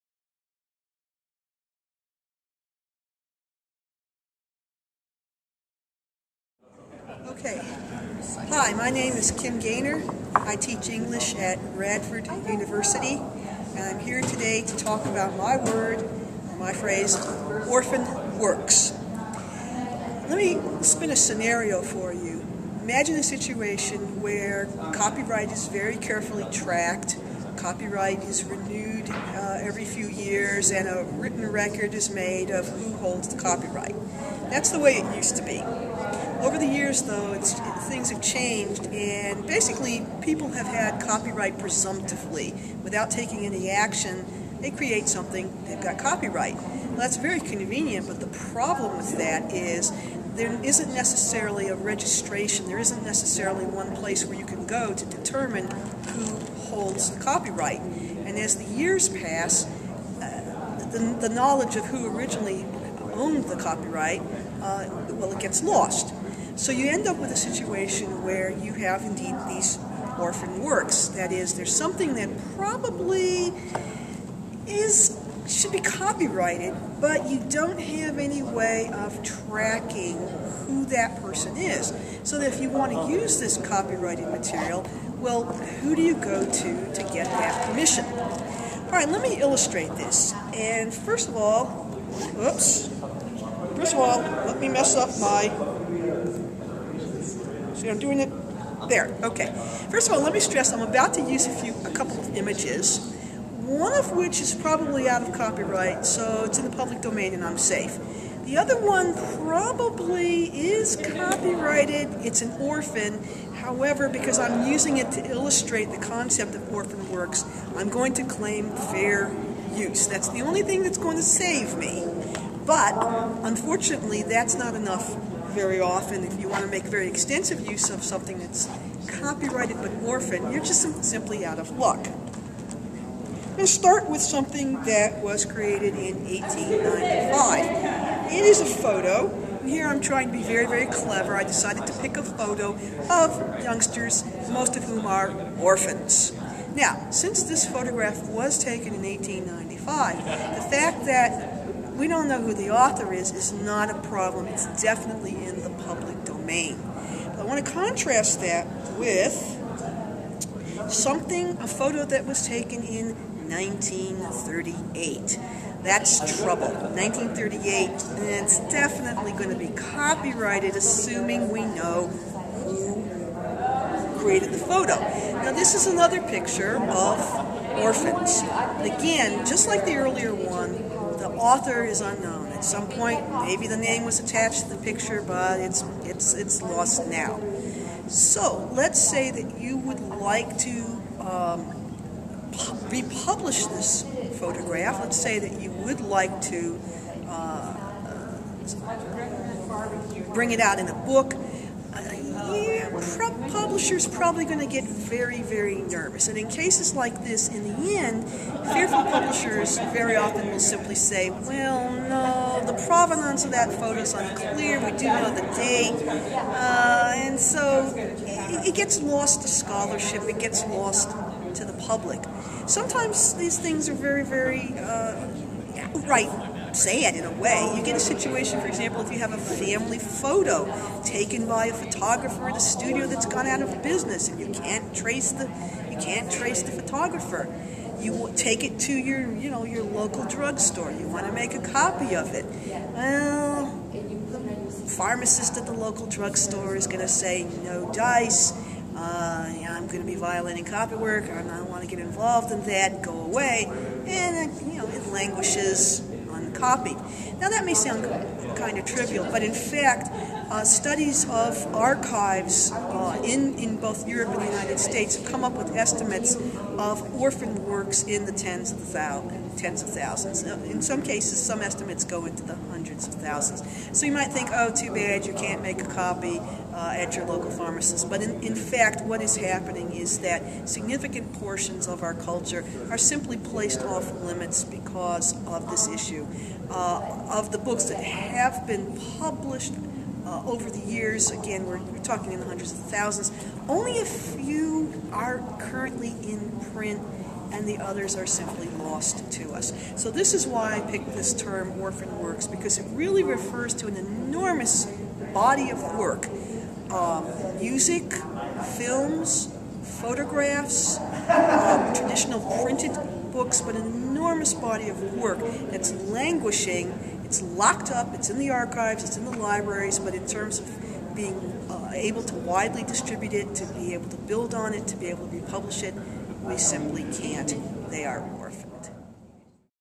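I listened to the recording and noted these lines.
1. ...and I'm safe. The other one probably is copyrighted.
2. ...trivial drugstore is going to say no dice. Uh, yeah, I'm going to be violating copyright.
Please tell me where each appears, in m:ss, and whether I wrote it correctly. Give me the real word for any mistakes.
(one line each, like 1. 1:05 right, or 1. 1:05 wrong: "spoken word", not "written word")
1. 1:47 right
2. 4:05 wrong: "local", not "trivial".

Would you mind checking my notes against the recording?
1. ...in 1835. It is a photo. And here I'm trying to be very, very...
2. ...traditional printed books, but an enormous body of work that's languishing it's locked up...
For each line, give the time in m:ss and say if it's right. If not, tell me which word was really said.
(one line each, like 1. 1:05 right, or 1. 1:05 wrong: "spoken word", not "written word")
1. 2:15 wrong: "1895", not "1835"
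2. 5:11 right.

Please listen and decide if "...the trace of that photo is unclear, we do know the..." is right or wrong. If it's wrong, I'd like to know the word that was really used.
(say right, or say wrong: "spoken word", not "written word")
wrong: "provenance", not "trace".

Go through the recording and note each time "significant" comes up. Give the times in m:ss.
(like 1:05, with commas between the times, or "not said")
4:40.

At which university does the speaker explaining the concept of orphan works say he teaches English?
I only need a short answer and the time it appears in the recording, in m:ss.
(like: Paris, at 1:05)
Radford University, at 0:11.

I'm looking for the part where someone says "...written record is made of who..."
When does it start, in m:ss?
0:31.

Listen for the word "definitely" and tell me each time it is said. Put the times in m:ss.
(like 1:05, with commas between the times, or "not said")
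2:34, 2:48.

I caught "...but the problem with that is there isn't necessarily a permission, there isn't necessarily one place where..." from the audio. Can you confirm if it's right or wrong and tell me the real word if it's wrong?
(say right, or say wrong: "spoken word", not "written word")
wrong: "registration", not "permission".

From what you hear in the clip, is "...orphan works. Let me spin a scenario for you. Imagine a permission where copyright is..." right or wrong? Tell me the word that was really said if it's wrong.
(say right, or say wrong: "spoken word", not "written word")
wrong: "situation", not "permission".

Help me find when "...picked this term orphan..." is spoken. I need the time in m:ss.
5:00.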